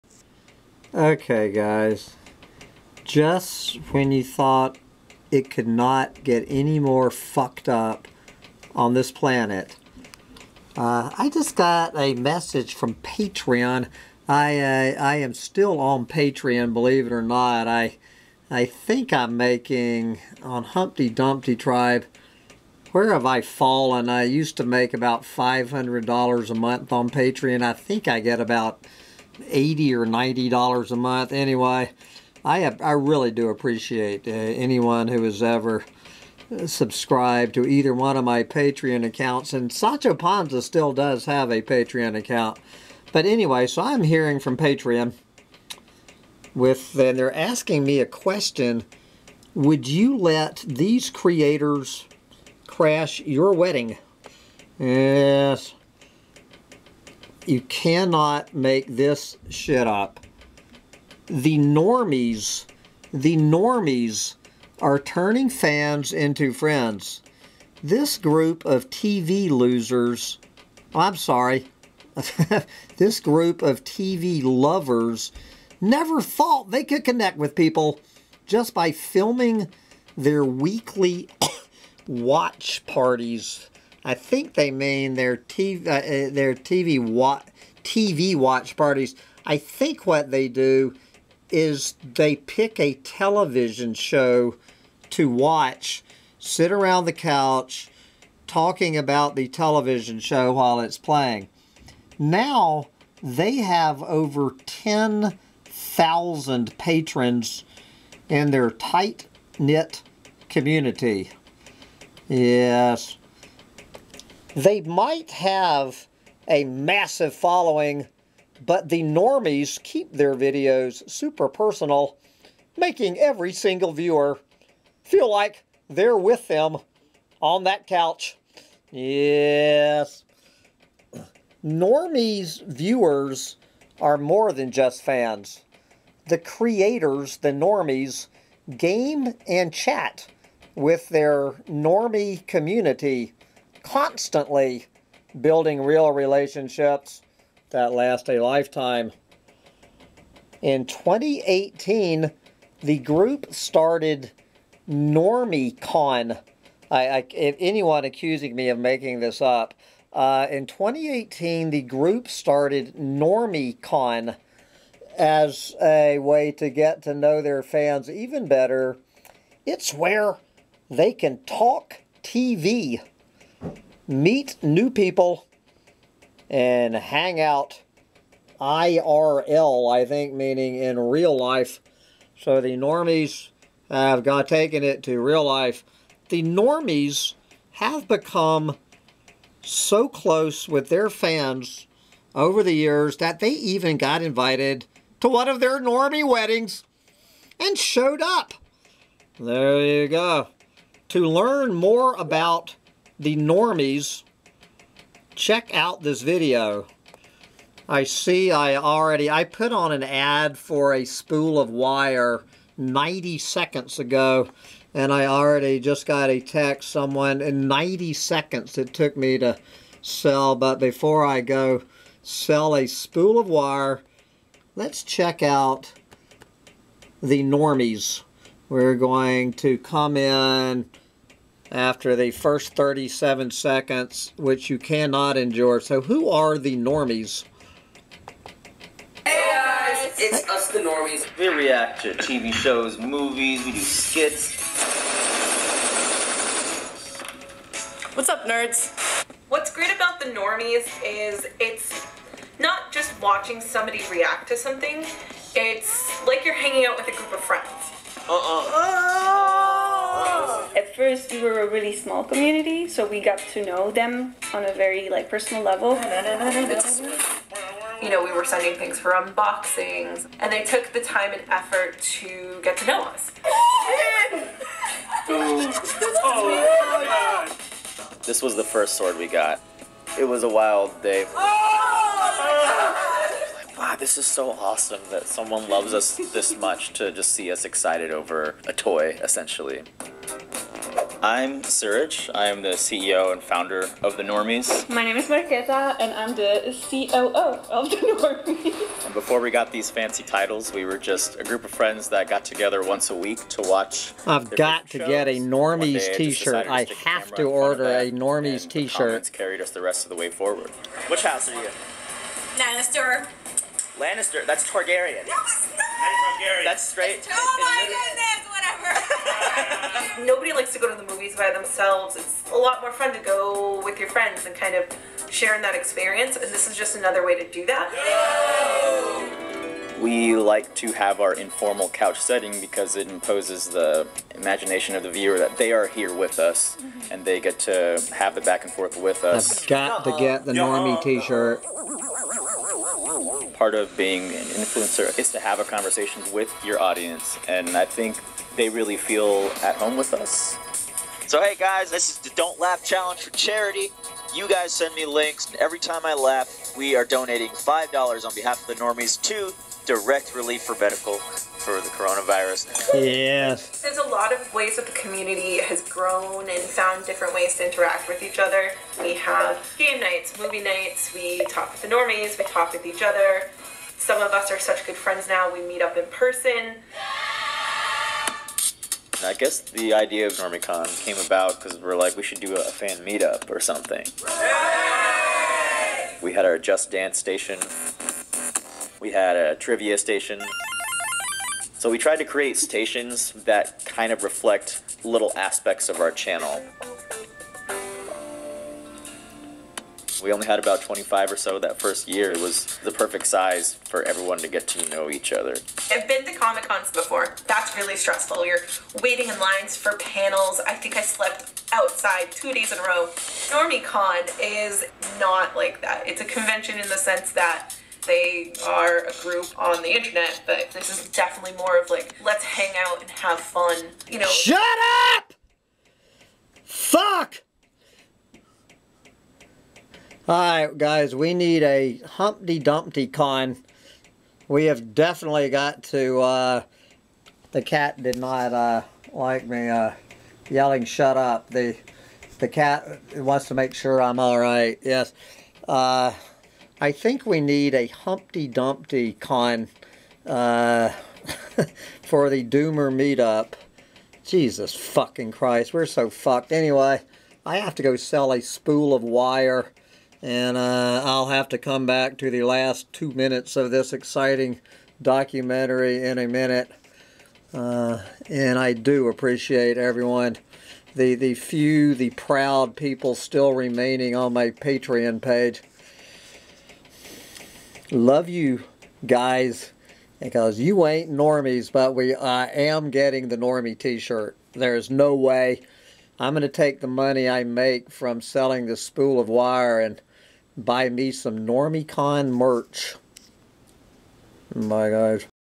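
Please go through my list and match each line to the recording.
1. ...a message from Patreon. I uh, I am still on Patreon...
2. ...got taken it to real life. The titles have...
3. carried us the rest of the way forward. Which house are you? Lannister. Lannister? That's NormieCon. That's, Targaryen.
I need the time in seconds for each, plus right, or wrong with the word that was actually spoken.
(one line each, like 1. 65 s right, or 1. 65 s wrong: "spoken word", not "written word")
1. 11 s right
2. 184 s wrong: "normies", not "titles"
3. 309 s wrong: "Targaryen", not "NormieCon".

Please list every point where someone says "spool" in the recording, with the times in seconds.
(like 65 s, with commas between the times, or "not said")
211 s, 222 s, 458 s, 488 s.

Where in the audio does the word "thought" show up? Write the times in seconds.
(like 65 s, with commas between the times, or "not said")
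4 s, 76 s.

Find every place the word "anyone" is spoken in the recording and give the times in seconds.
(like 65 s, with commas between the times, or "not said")
34 s, 157 s.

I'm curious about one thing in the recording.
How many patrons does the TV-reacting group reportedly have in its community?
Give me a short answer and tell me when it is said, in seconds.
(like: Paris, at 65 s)
over 10,000, at 104 s.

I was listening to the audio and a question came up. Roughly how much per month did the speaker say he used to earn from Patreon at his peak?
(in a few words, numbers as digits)
$500.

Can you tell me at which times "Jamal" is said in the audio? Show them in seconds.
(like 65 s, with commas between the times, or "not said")
not said.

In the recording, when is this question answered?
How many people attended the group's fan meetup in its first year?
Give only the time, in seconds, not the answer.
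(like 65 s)
400 s.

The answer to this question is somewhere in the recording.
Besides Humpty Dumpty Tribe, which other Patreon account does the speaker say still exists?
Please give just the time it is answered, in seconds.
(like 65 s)
39 s.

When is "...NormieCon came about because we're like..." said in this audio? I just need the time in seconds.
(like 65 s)
380 s.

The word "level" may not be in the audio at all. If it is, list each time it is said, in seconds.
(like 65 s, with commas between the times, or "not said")
265 s.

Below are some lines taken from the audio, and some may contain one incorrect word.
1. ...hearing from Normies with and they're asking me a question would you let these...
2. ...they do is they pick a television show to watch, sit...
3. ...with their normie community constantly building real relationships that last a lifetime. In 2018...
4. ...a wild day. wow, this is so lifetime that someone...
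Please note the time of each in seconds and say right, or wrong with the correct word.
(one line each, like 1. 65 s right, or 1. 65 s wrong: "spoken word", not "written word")
1. 44 s wrong: "Patreon", not "Normies"
2. 90 s right
3. 140 s right
4. 280 s wrong: "awesome", not "lifetime".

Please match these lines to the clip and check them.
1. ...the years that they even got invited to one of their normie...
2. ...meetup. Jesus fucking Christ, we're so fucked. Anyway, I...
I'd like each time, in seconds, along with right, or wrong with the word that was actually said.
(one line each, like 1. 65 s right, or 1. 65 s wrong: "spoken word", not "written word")
1. 192 s right
2. 452 s right.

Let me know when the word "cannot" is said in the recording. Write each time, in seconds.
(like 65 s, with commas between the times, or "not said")
57 s, 234 s.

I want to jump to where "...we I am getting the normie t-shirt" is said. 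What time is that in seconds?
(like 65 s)
481 s.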